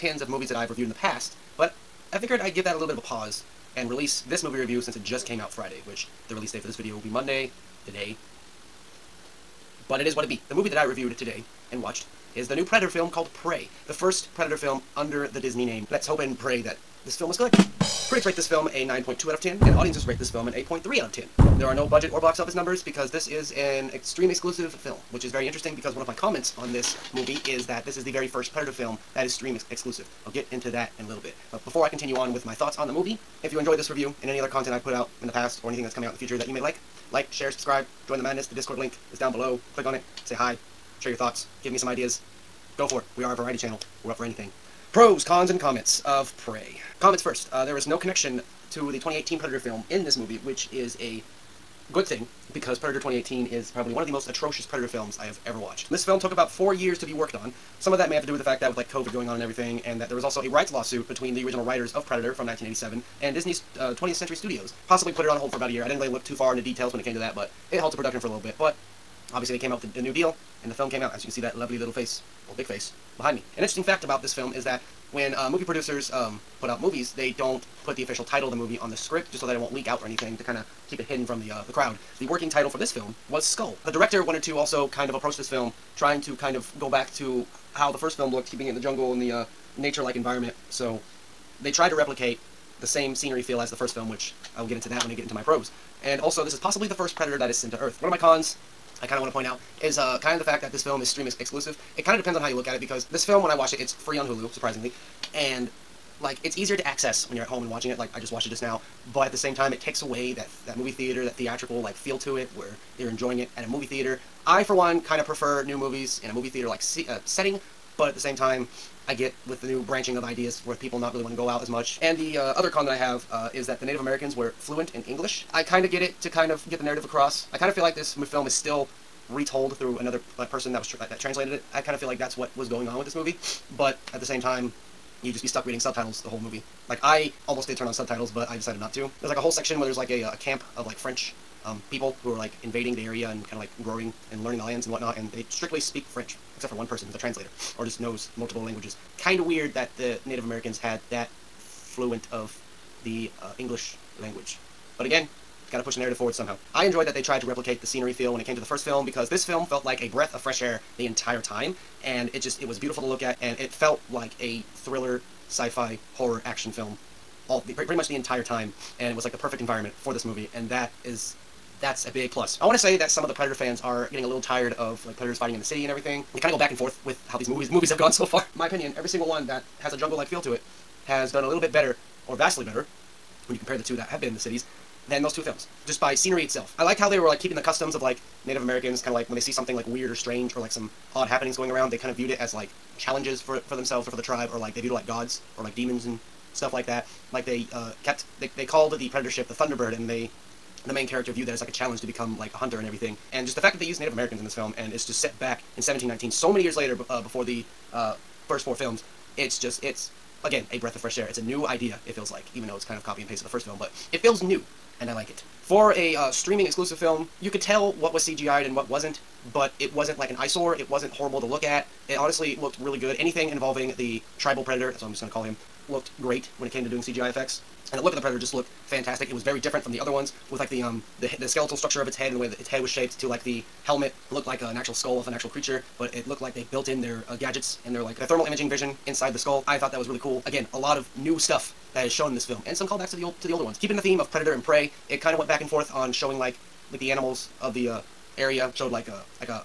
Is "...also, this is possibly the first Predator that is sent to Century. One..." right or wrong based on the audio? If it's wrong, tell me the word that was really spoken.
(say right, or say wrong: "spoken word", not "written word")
wrong: "Earth", not "Century".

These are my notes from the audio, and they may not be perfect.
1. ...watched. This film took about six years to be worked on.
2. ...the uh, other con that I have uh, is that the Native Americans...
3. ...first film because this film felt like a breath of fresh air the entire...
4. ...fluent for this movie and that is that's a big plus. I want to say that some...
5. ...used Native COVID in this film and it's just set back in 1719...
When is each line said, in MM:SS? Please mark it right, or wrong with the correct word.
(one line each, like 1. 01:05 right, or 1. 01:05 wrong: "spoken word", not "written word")
1. 00:55 wrong: "four", not "six"
2. 02:02 right
3. 02:38 right
4. 02:49 wrong: "environment", not "fluent"
5. 03:23 wrong: "Americans", not "COVID".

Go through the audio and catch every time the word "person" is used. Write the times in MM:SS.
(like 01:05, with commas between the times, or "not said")
02:10, 02:26.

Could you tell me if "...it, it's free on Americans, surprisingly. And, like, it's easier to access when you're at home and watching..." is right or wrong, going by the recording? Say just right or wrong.
wrong.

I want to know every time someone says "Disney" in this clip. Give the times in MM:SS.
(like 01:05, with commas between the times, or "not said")
00:15, 01:03.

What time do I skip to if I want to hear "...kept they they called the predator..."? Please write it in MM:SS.
03:18.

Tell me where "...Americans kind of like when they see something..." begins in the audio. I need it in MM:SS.
03:08.